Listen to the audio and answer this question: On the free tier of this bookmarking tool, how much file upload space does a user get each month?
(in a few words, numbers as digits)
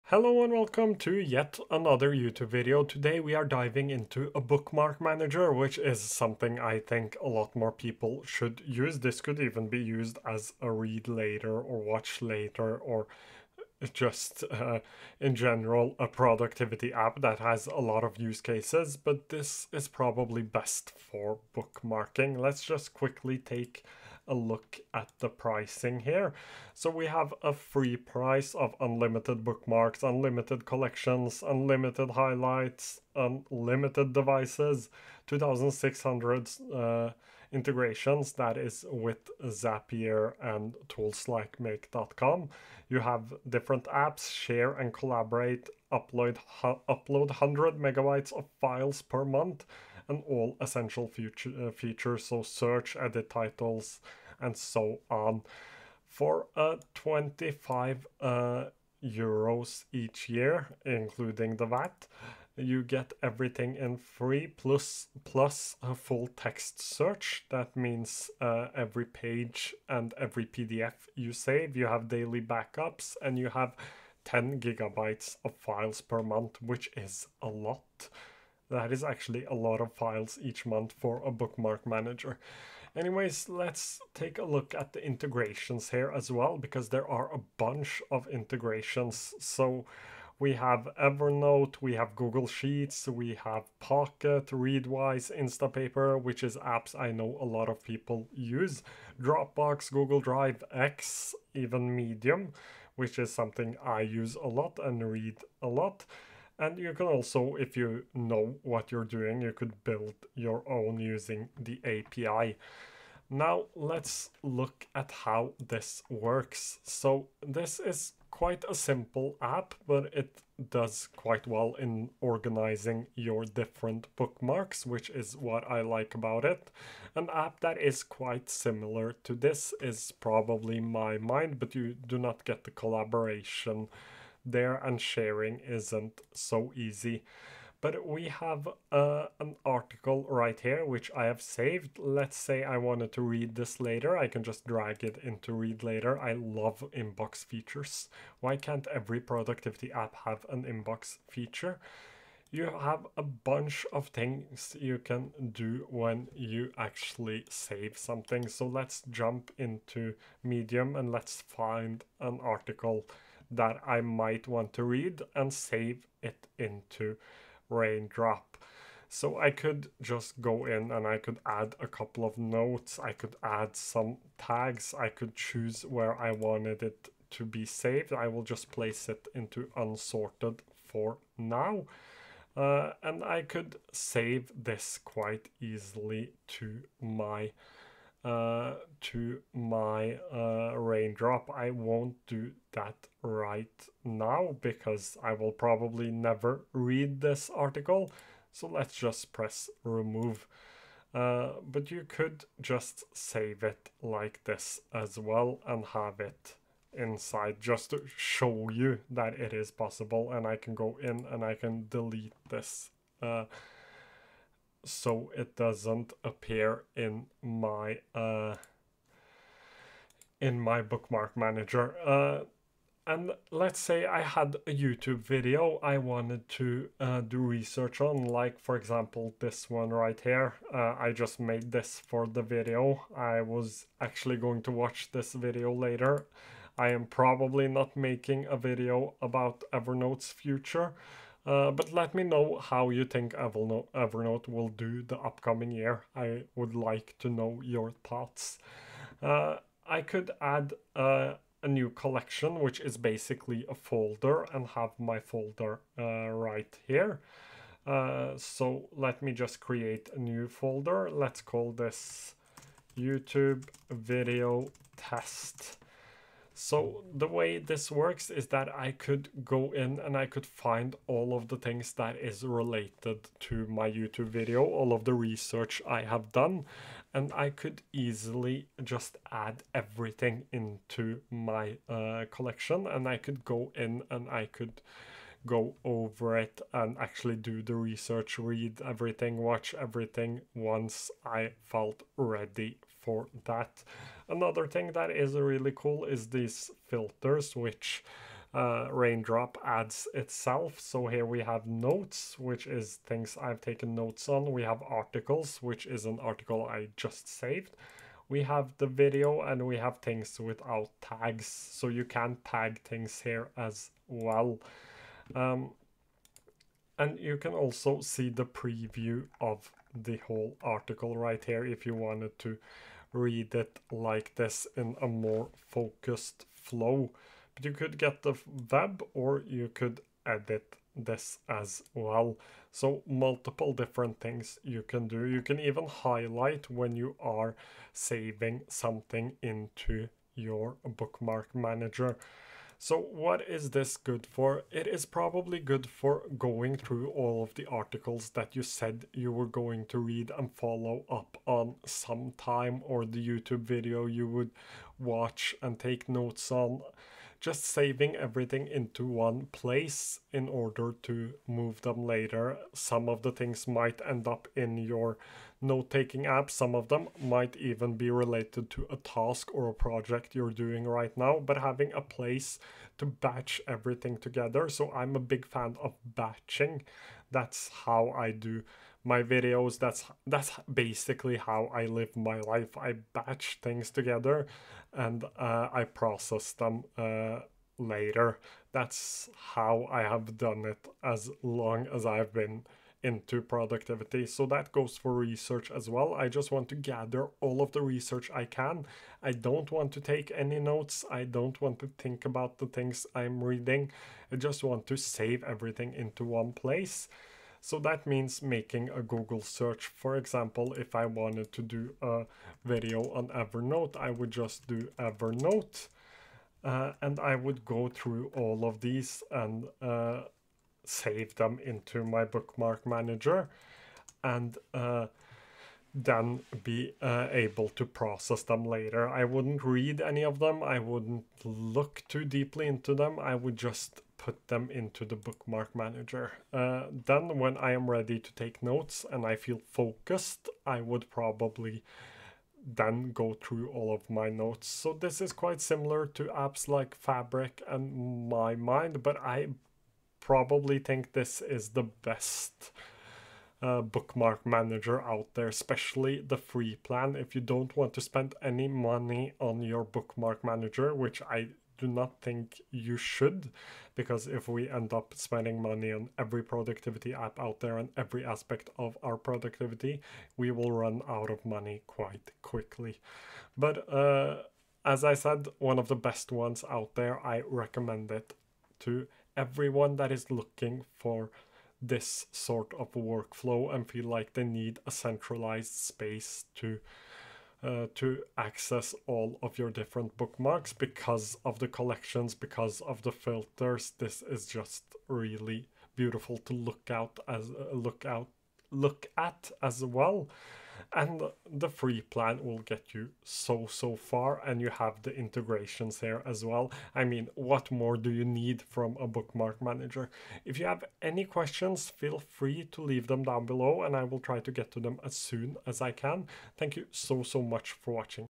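100 megabytes.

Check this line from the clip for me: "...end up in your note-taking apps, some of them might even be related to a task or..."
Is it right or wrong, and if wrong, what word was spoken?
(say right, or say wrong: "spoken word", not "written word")
right.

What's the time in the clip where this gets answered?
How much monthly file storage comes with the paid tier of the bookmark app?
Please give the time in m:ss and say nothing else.
1:14.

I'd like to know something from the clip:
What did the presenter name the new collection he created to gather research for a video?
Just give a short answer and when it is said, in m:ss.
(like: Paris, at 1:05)
YouTube video test, at 4:22.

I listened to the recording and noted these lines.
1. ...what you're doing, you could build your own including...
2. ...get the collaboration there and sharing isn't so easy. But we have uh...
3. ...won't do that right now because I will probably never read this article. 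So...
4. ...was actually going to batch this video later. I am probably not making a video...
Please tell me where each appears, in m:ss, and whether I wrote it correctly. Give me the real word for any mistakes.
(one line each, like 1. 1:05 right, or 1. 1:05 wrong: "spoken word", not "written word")
1. 1:48 wrong: "using", not "including"
2. 2:12 right
3. 3:11 right
4. 3:53 wrong: "watch", not "batch".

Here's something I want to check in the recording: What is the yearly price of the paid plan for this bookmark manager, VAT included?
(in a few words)
25 euros.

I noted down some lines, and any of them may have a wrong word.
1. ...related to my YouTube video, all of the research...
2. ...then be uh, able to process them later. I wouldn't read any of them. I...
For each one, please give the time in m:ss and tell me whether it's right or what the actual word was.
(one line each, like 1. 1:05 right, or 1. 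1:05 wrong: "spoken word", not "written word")
1. 4:32 right
2. 7:05 right.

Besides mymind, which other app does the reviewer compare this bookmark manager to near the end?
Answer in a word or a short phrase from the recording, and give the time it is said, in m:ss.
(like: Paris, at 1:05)
Fabric, at 7:26.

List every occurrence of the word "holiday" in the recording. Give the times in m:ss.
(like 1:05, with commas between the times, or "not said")
not said.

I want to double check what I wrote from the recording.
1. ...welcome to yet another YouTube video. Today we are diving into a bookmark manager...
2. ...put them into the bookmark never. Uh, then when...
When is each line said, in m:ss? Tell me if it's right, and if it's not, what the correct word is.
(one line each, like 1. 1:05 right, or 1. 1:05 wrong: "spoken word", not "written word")
1. 0:00 right
2. 7:14 wrong: "manager", not "never".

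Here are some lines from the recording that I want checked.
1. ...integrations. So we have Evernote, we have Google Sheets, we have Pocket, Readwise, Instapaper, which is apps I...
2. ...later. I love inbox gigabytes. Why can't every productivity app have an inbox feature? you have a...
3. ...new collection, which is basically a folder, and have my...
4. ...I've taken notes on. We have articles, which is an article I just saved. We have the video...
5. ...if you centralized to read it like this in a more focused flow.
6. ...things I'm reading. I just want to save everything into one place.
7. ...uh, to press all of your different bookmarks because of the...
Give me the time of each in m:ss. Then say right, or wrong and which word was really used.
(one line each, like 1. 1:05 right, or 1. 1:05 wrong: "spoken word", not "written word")
1. 1:28 right
2. 2:25 wrong: "features", not "gigabytes"
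3. 4:11 right
4. 5:03 right
5. 5:21 wrong: "wanted", not "centralized"
6. 6:42 right
7. 8:07 wrong: "access", not "press".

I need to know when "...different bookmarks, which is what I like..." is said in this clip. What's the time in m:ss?
2:03.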